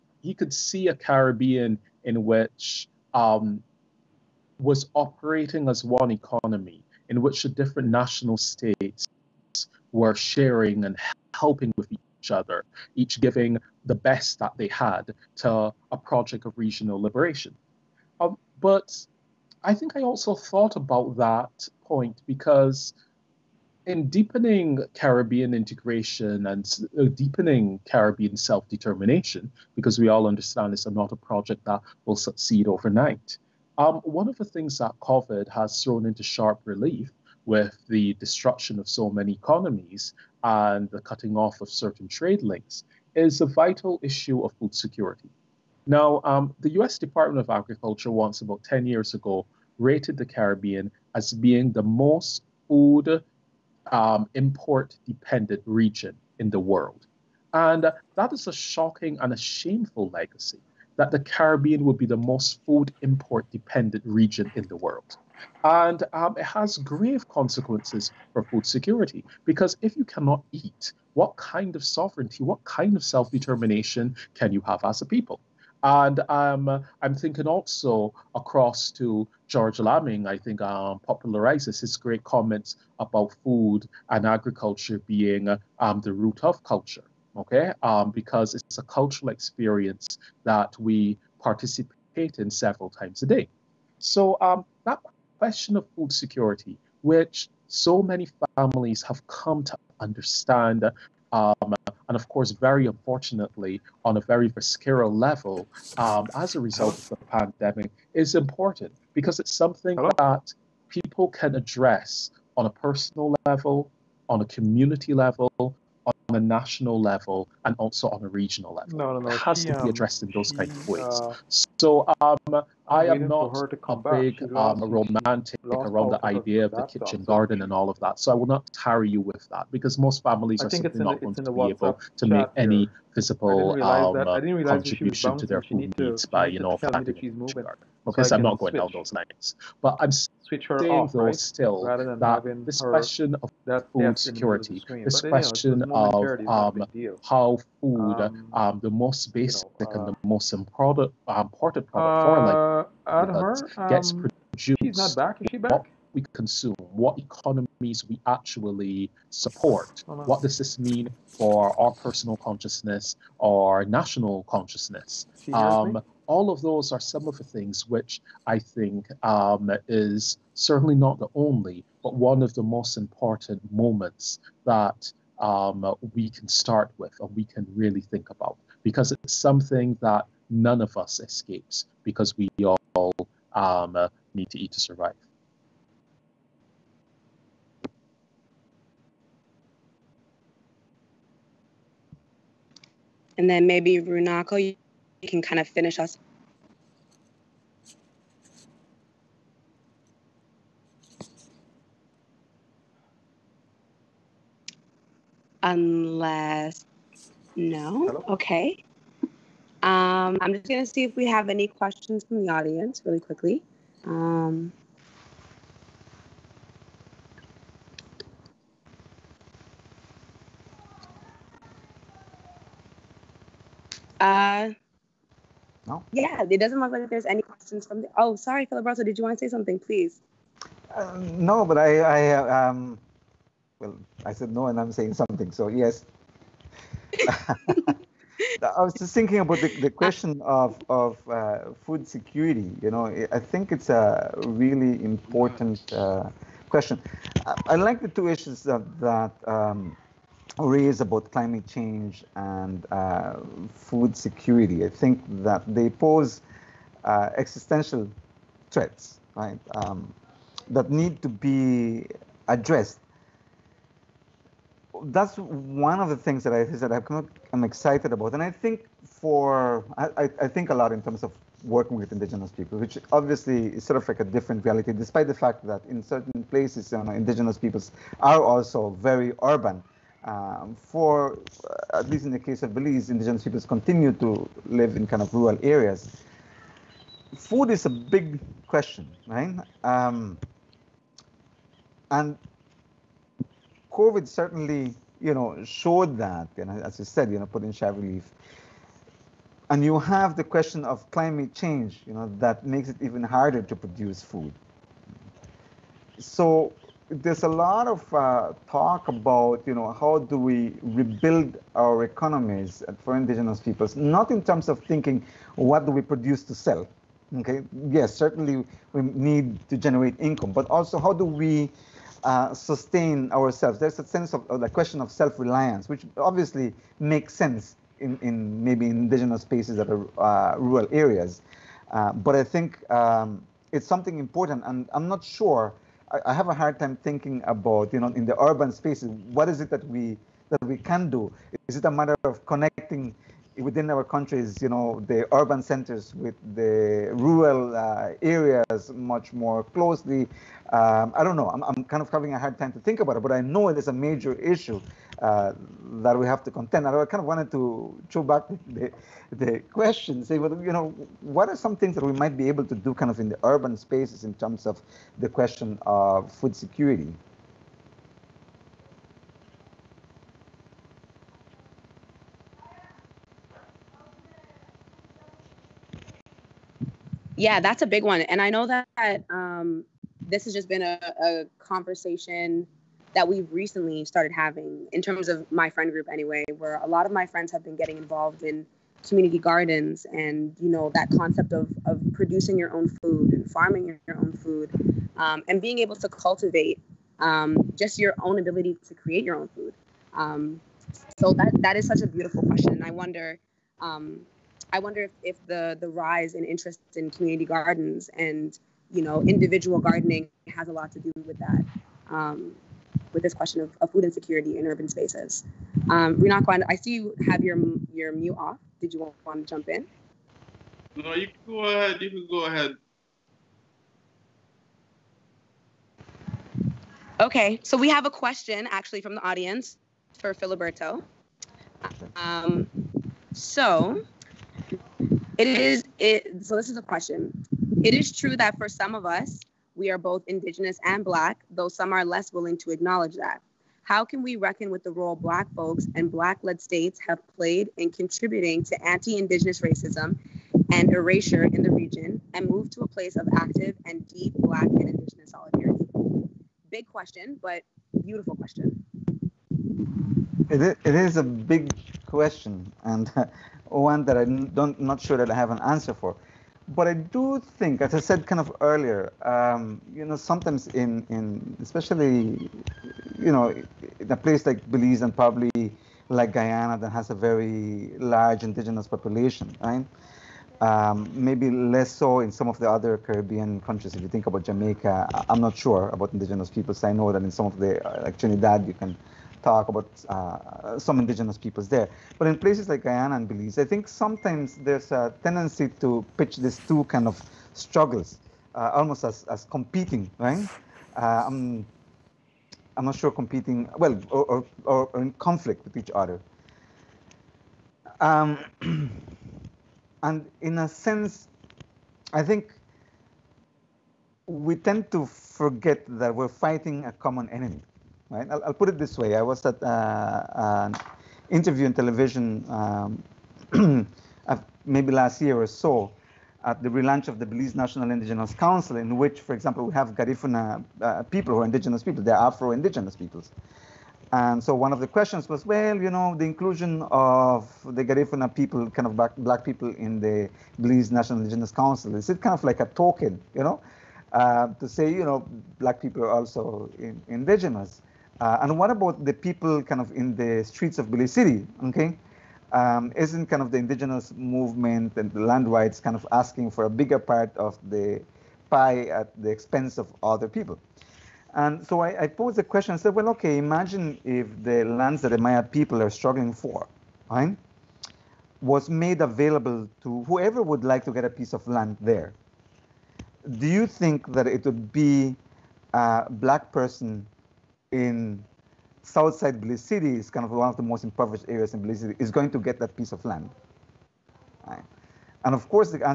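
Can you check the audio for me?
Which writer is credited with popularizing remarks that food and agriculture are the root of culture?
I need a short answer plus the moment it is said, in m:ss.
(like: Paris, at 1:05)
George Lamming, at 1:19.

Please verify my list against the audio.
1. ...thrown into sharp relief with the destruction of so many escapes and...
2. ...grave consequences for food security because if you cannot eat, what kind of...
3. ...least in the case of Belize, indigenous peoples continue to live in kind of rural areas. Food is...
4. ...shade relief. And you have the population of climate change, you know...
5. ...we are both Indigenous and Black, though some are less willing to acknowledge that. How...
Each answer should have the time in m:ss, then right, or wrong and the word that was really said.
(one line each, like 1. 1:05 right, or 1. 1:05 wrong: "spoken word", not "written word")
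1. 0:35 wrong: "economies", not "escapes"
2. 1:06 right
3. 4:42 right
4. 4:57 wrong: "question", not "population"
5. 7:19 right.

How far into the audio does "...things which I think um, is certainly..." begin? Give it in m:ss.
2:47.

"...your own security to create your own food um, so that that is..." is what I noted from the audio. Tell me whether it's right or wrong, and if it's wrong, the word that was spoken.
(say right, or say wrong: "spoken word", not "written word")
wrong: "ability", not "security".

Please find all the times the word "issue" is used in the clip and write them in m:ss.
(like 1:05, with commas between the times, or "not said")
0:44, 4:08, 5:54.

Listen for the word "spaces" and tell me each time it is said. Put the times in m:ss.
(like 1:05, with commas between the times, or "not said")
5:29, 5:38, 6:03, 6:54.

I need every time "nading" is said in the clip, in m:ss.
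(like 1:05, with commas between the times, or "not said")
not said.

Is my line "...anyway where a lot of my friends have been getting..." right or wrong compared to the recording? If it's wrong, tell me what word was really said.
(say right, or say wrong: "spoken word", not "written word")
right.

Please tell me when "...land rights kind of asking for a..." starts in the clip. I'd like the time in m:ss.
9:15.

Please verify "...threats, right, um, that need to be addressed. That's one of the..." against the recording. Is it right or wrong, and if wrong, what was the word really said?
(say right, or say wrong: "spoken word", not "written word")
right.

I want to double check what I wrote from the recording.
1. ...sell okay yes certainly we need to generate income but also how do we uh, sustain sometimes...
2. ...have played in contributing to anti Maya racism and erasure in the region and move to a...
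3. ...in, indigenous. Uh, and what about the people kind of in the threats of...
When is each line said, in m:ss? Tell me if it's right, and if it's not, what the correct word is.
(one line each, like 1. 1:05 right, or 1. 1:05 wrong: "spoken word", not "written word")
1. 5:16 wrong: "ourselves", not "sometimes"
2. 7:27 wrong: "Indigenous", not "Maya"
3. 9:06 wrong: "streets", not "threats".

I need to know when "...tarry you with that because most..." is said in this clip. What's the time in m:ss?
2:08.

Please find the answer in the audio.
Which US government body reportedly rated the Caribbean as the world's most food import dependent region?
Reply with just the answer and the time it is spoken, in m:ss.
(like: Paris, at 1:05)
US Department of Agriculture, at 0:46.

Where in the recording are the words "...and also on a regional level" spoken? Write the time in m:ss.
1:57.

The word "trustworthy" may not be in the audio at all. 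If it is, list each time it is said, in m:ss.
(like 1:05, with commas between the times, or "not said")
not said.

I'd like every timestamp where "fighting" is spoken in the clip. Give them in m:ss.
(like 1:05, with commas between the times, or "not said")
8:36.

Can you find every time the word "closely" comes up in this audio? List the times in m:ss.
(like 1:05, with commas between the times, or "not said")
5:49.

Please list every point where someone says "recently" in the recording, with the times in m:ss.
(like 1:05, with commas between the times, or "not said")
6:23.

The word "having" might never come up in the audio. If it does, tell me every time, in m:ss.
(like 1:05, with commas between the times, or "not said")
5:52, 6:24.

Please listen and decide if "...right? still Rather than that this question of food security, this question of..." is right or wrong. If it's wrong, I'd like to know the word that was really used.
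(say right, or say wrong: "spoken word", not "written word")
right.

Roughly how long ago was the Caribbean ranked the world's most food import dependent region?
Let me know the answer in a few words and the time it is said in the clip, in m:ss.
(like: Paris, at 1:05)
10 years, at 0:48.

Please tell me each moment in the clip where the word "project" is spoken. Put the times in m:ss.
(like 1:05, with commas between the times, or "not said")
0:15, 0:31.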